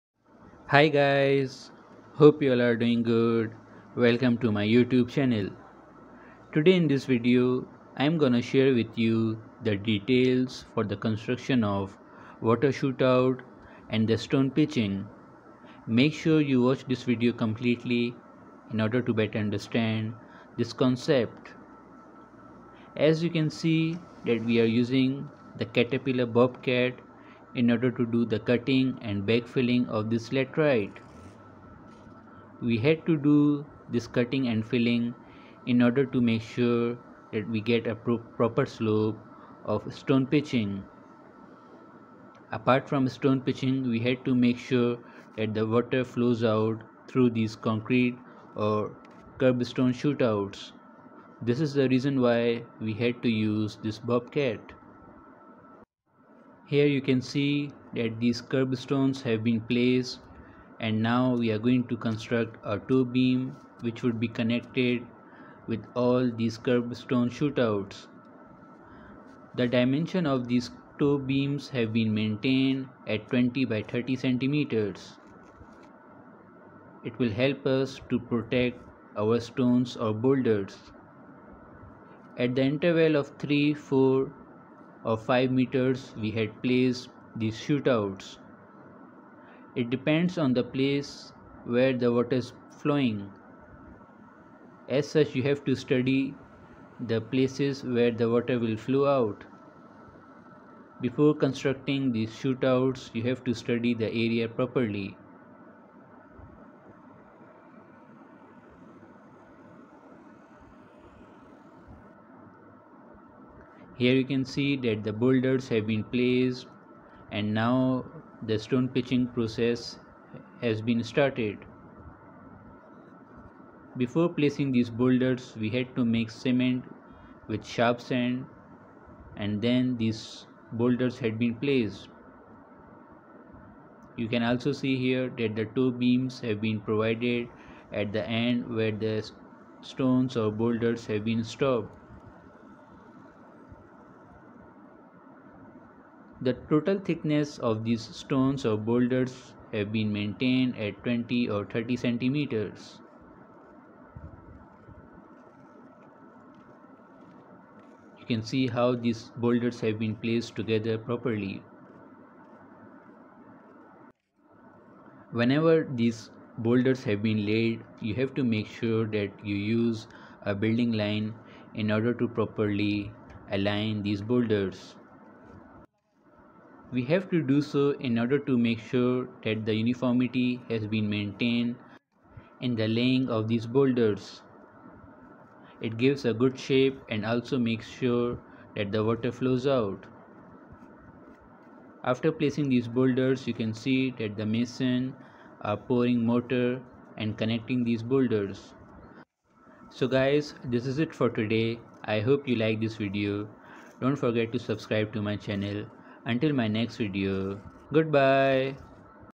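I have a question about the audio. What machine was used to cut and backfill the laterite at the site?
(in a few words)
Caterpillar bobcat.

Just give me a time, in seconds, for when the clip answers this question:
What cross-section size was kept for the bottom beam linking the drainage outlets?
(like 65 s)
73 s.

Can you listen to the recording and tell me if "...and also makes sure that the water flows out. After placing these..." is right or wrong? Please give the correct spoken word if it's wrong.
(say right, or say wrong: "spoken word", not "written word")
right.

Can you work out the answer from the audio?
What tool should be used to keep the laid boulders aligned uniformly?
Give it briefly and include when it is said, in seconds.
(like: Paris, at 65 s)
Building line, at 170 s.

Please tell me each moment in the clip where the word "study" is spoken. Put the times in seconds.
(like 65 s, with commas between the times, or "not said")
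95 s, 103 s.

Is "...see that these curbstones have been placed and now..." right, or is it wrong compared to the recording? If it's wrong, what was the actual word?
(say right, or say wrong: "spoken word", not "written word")
right.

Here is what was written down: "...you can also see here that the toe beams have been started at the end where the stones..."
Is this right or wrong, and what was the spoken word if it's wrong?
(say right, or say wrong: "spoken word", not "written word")
wrong: "provided", not "started".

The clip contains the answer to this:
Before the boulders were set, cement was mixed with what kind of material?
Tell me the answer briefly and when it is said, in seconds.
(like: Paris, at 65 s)
Sharp sand, at 127 s.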